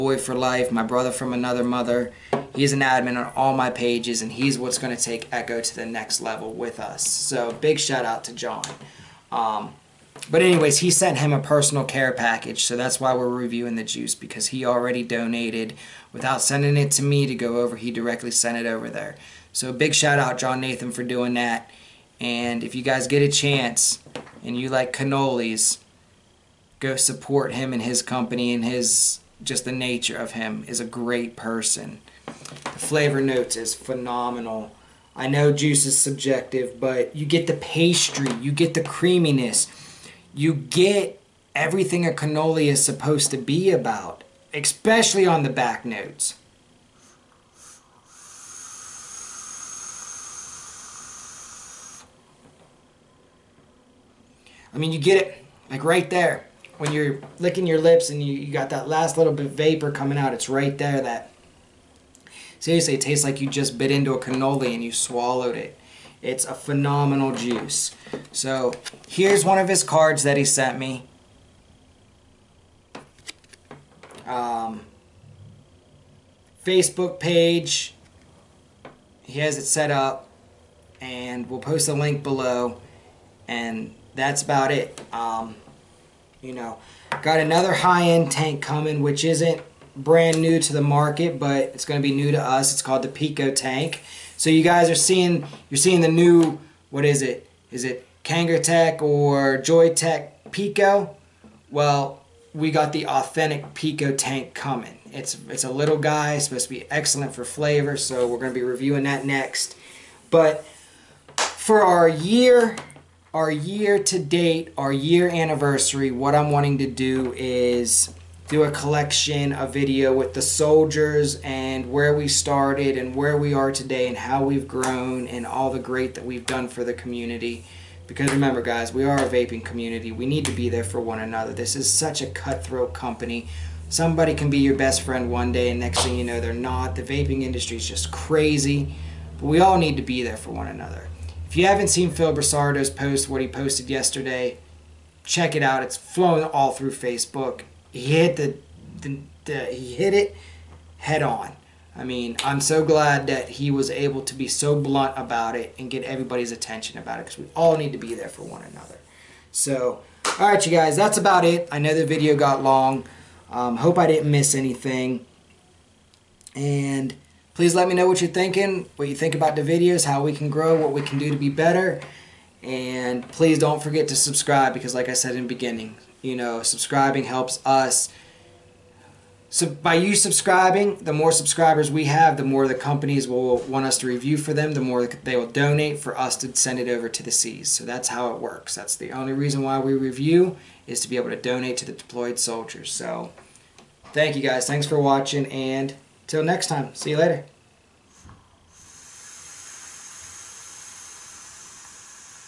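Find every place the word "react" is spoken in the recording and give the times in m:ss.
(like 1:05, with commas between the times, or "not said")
not said.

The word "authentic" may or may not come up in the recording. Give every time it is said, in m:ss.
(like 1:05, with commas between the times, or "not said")
1:43.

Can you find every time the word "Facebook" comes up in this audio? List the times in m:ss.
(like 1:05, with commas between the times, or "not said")
1:16, 2:26.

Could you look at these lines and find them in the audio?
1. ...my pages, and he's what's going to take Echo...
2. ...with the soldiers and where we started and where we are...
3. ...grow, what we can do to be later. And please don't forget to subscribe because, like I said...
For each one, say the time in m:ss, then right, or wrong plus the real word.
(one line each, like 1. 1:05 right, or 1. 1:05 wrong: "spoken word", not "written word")
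1. 0:03 right
2. 2:00 right
3. 2:50 wrong: "better", not "later".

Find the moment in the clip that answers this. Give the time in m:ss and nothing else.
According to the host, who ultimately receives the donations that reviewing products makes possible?
3:11.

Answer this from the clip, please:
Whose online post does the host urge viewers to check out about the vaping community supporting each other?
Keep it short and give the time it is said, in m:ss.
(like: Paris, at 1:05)
Phil Busardo, at 2:22.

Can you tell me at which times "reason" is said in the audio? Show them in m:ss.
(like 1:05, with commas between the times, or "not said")
3:09.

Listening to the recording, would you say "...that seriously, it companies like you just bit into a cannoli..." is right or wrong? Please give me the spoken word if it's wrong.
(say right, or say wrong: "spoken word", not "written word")
wrong: "tastes", not "companies".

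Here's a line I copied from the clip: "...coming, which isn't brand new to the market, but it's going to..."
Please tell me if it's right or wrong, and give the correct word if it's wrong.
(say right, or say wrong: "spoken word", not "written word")
right.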